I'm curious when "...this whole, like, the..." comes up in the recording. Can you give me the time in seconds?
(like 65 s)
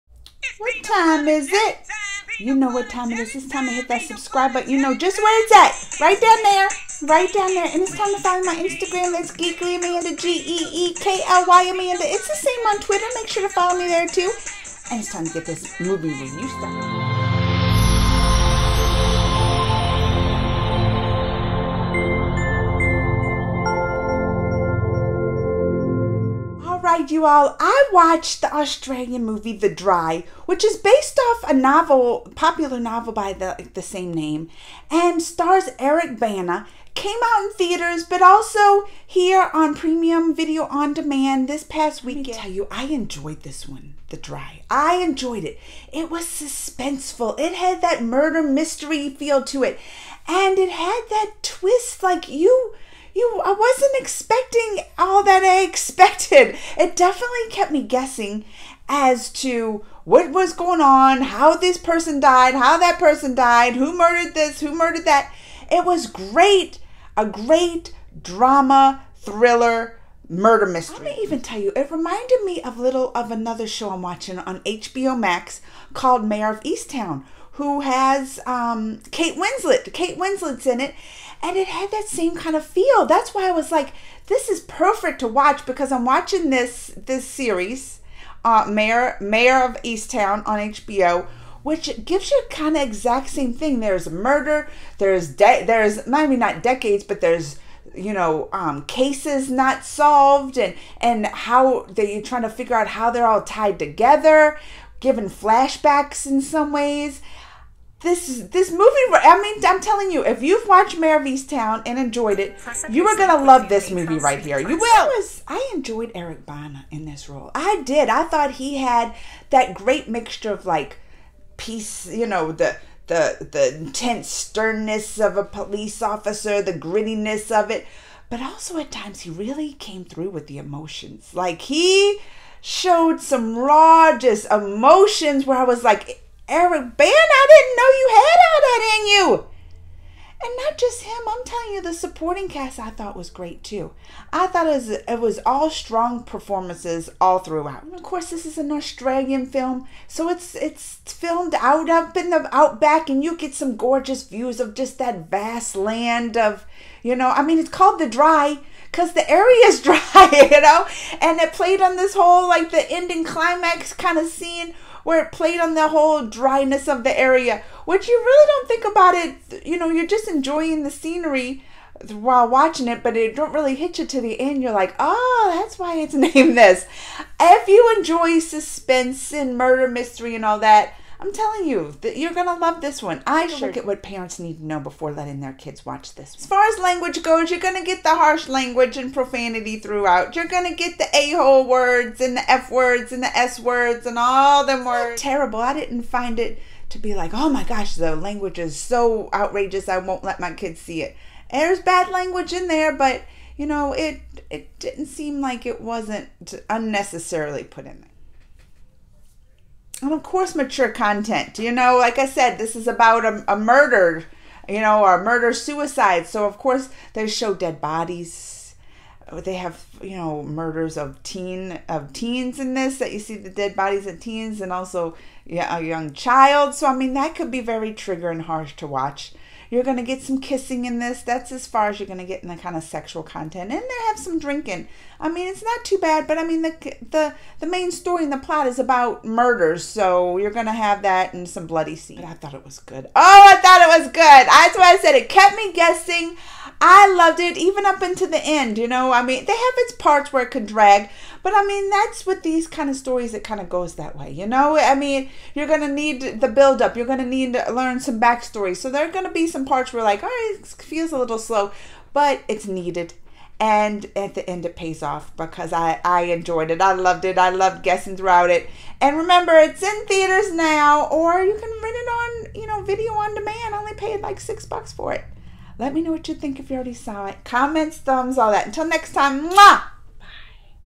161 s.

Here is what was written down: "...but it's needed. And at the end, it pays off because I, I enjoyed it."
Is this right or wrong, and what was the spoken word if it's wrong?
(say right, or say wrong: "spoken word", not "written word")
right.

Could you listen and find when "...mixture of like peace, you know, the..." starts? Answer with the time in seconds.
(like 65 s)
120 s.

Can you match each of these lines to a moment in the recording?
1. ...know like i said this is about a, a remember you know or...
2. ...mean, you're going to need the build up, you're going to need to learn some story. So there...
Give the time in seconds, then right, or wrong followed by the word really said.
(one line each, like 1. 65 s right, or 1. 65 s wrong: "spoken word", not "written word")
1. 211 s wrong: "murder", not "remember"
2. 254 s wrong: "backstory", not "story".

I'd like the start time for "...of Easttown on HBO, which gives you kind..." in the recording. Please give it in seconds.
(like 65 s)
89 s.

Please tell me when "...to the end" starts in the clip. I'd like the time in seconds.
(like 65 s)
174 s.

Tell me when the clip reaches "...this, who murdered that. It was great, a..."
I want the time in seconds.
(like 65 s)
64 s.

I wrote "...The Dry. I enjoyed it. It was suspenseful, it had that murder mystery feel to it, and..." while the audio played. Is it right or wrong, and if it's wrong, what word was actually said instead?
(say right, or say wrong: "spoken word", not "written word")
right.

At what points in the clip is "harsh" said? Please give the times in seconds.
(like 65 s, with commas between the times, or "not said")
188 s, 228 s.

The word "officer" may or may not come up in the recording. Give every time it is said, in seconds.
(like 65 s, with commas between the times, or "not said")
126 s.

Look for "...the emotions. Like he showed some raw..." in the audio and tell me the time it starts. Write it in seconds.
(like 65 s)
130 s.